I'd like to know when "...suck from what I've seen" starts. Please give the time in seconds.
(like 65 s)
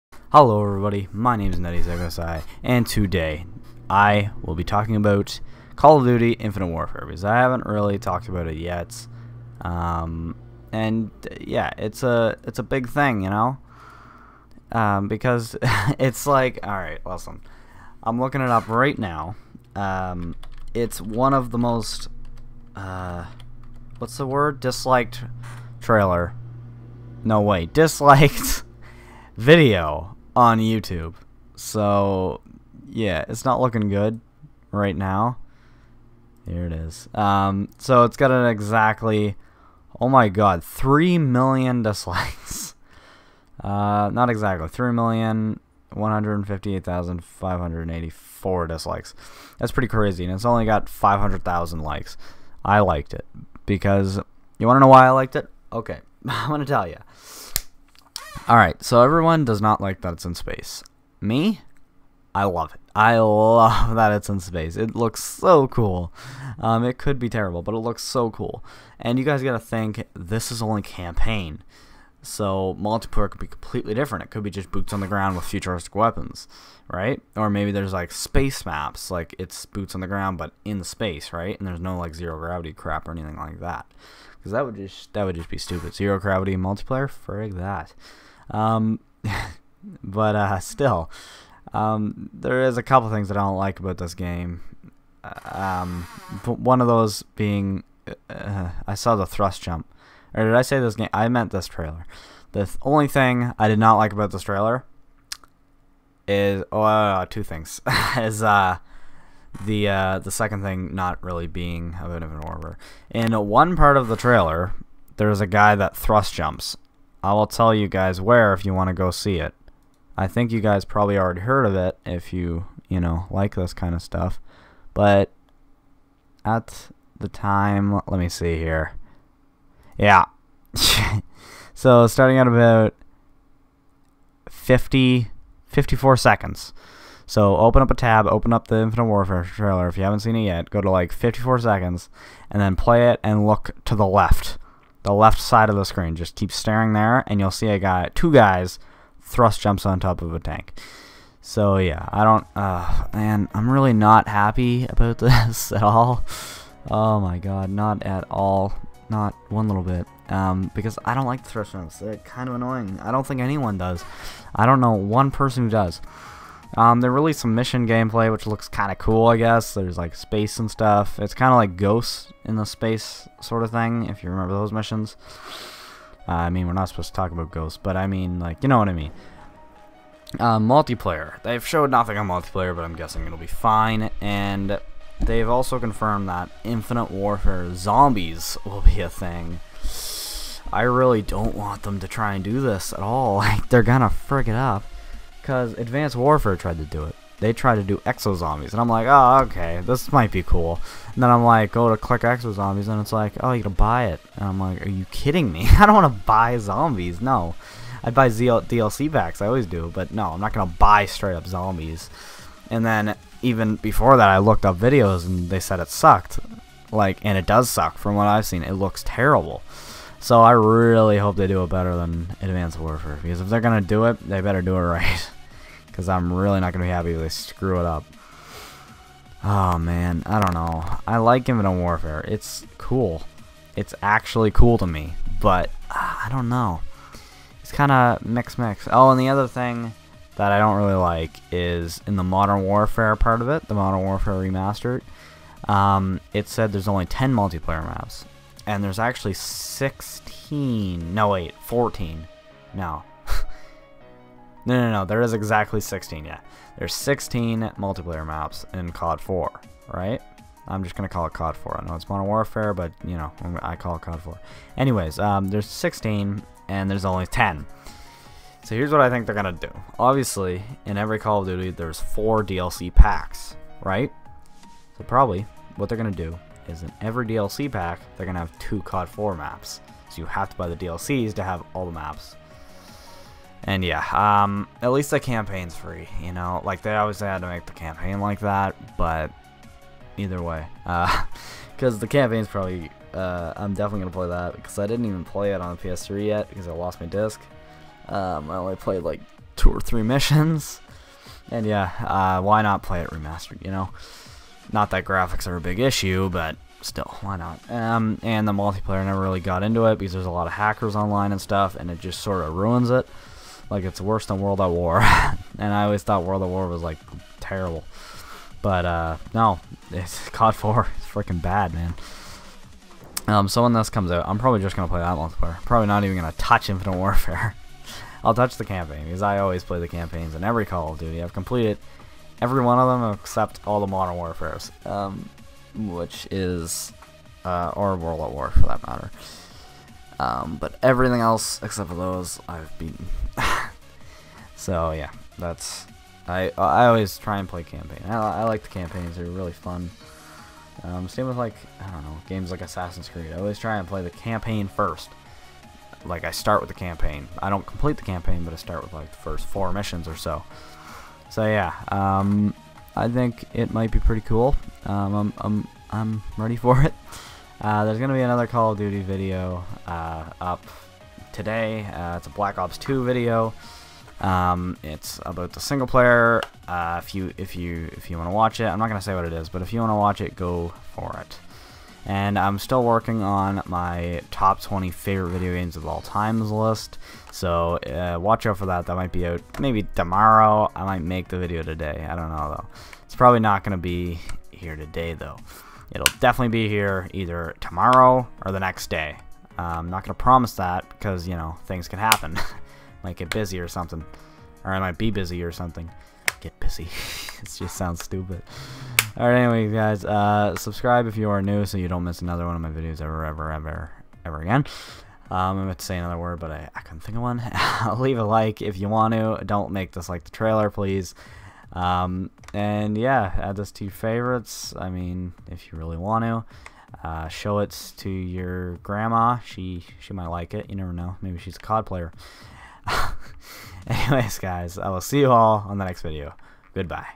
217 s.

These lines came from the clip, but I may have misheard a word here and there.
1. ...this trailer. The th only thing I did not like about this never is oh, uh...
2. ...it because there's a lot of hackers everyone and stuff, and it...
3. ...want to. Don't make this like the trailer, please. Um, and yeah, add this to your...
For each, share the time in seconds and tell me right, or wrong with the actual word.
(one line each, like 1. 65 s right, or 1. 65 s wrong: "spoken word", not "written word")
1. 101 s wrong: "trailer", not "never"
2. 309 s wrong: "online", not "everyone"
3. 418 s right.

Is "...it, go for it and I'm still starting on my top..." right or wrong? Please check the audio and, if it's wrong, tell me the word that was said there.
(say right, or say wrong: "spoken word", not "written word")
wrong: "working", not "starting".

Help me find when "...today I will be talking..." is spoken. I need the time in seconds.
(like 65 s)
2 s.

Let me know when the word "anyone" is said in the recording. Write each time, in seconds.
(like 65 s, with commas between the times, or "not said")
163 s.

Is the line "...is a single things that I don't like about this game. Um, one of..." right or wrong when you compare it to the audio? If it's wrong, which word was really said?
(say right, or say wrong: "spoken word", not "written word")
wrong: "couple", not "single".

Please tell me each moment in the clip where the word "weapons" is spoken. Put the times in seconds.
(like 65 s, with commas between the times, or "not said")
75 s.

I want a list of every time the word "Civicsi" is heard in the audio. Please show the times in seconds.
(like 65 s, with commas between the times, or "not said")
1 s.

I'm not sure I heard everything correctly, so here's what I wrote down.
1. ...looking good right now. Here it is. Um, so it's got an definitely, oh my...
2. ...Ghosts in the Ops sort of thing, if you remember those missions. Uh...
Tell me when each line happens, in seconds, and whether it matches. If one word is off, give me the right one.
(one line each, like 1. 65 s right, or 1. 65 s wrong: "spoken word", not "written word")
1. 33 s wrong: "exactly", not "definitely"
2. 171 s wrong: "Space", not "Ops".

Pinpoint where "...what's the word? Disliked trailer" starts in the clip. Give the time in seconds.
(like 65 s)
23 s.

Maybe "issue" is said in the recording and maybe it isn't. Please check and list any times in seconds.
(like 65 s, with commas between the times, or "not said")
305 s.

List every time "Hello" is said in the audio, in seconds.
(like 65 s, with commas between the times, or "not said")
0 s.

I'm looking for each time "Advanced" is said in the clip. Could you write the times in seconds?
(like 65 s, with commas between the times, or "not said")
195 s, 222 s.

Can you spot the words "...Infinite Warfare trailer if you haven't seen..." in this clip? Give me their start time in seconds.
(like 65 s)
138 s.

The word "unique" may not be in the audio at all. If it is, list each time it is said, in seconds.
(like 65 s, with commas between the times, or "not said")
not said.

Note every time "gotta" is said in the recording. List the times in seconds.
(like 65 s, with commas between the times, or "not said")
69 s, 203 s.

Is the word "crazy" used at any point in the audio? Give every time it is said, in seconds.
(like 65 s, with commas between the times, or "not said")
49 s.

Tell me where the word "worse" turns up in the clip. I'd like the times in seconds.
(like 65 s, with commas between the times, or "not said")
314 s.